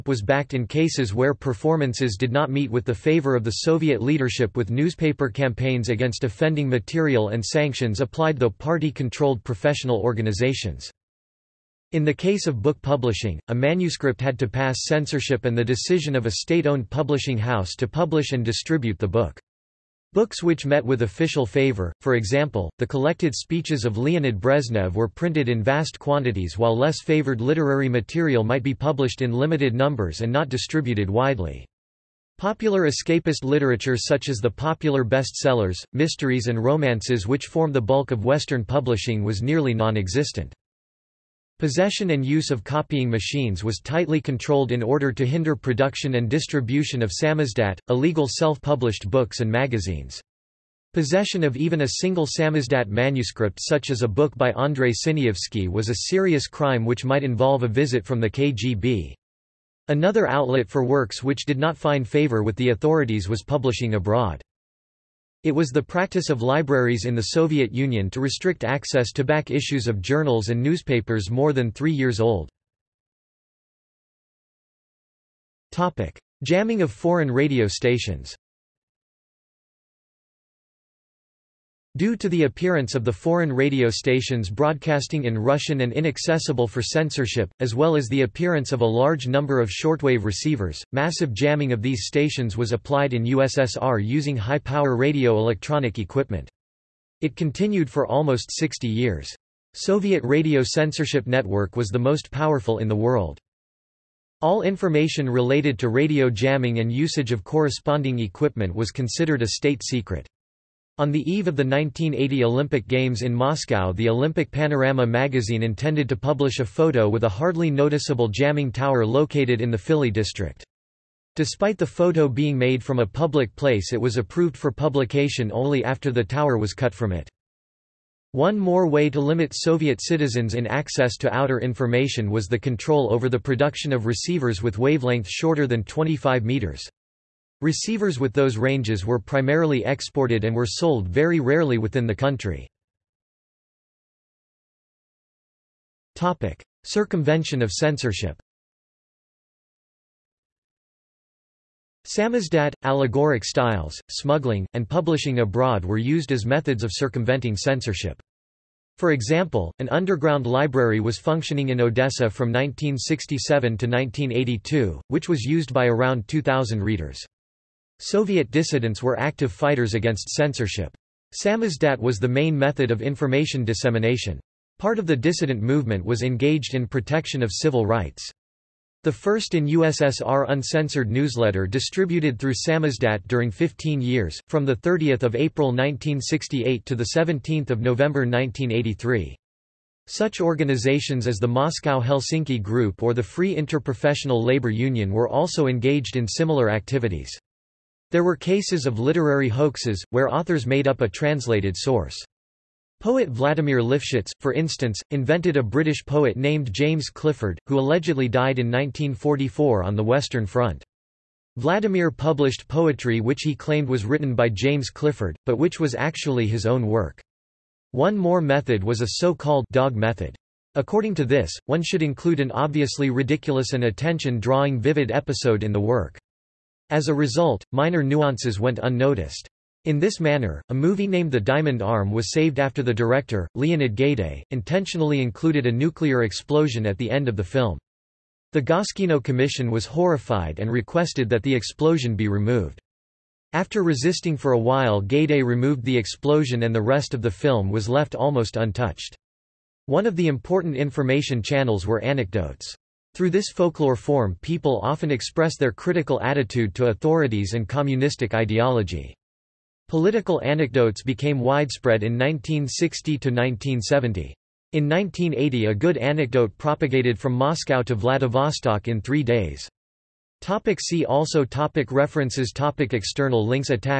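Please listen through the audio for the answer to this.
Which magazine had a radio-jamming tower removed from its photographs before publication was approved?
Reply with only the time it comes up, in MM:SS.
01:54.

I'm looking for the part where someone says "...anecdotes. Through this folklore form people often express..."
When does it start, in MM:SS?
04:12.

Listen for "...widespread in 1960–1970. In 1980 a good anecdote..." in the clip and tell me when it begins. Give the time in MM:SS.
04:21.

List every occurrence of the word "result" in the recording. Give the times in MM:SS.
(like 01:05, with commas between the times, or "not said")
03:47.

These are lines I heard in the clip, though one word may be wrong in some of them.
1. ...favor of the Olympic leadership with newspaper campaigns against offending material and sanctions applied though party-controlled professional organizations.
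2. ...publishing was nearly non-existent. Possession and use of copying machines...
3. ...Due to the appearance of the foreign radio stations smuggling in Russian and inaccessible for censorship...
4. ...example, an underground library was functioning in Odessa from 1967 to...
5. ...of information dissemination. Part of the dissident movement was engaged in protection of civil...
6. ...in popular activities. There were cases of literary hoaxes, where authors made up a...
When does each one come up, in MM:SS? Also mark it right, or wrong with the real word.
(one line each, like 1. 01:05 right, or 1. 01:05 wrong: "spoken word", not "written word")
1. 00:02 wrong: "Soviet", not "Olympic"
2. 00:38 right
3. 01:21 wrong: "broadcasting", not "smuggling"
4. 02:39 right
5. 02:52 right
6. 03:16 wrong: "similar", not "popular".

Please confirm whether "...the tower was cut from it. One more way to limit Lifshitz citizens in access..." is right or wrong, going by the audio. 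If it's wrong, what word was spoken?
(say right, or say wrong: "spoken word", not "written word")
wrong: "Soviet", not "Lifshitz".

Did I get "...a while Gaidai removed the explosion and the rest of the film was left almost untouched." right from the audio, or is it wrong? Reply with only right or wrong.
right.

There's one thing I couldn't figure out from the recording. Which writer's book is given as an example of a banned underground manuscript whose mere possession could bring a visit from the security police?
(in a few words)
Andrei Sinyavsky.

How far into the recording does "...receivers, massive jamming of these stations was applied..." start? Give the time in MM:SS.
01:30.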